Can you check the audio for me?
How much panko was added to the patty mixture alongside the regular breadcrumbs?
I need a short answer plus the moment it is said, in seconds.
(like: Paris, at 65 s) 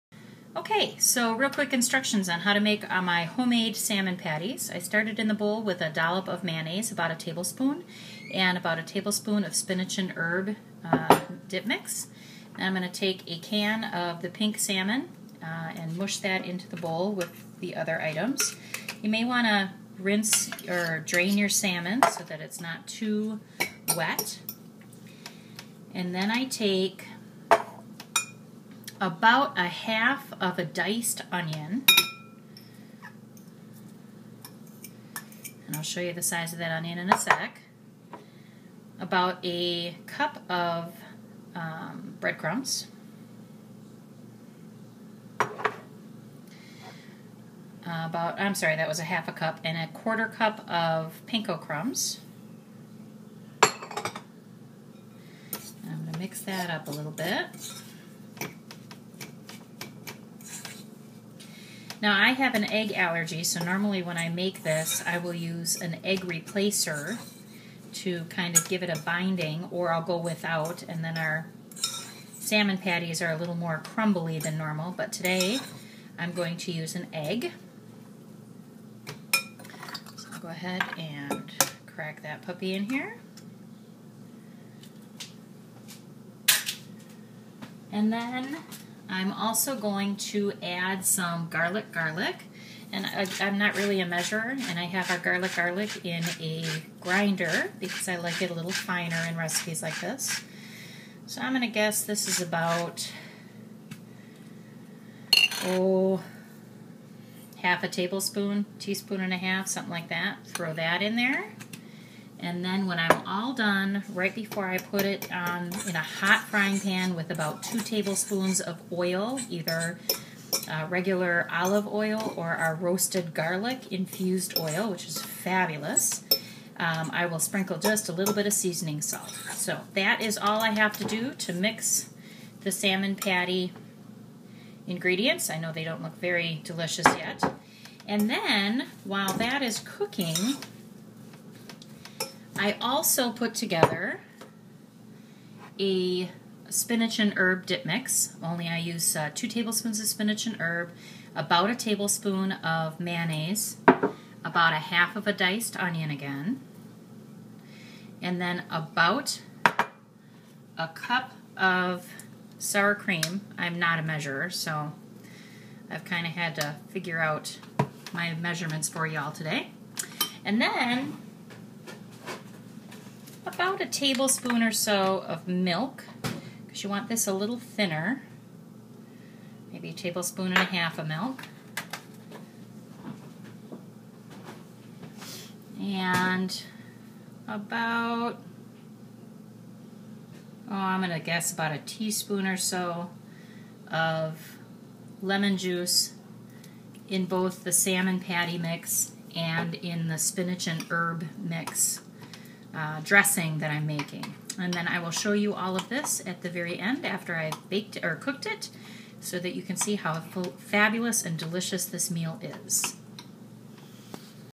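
a quarter cup, at 49 s.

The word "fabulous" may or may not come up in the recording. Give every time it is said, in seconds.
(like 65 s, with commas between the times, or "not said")
125 s, 210 s.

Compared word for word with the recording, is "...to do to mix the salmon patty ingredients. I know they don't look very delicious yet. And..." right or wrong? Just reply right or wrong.
right.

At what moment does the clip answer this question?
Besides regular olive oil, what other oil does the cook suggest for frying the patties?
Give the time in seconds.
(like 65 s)
122 s.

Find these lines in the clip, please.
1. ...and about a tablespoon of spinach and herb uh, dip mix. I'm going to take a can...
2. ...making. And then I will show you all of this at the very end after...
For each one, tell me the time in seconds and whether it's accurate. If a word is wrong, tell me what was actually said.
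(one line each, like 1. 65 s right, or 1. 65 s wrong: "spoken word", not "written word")
1. 8 s right
2. 203 s right.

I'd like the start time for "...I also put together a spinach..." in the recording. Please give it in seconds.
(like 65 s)
142 s.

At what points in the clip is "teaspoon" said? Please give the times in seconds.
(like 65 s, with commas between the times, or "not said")
108 s, 191 s.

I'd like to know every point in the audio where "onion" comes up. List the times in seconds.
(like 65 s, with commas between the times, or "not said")
31 s, 36 s, 155 s.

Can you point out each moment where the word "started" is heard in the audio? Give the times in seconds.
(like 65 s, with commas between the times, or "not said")
4 s.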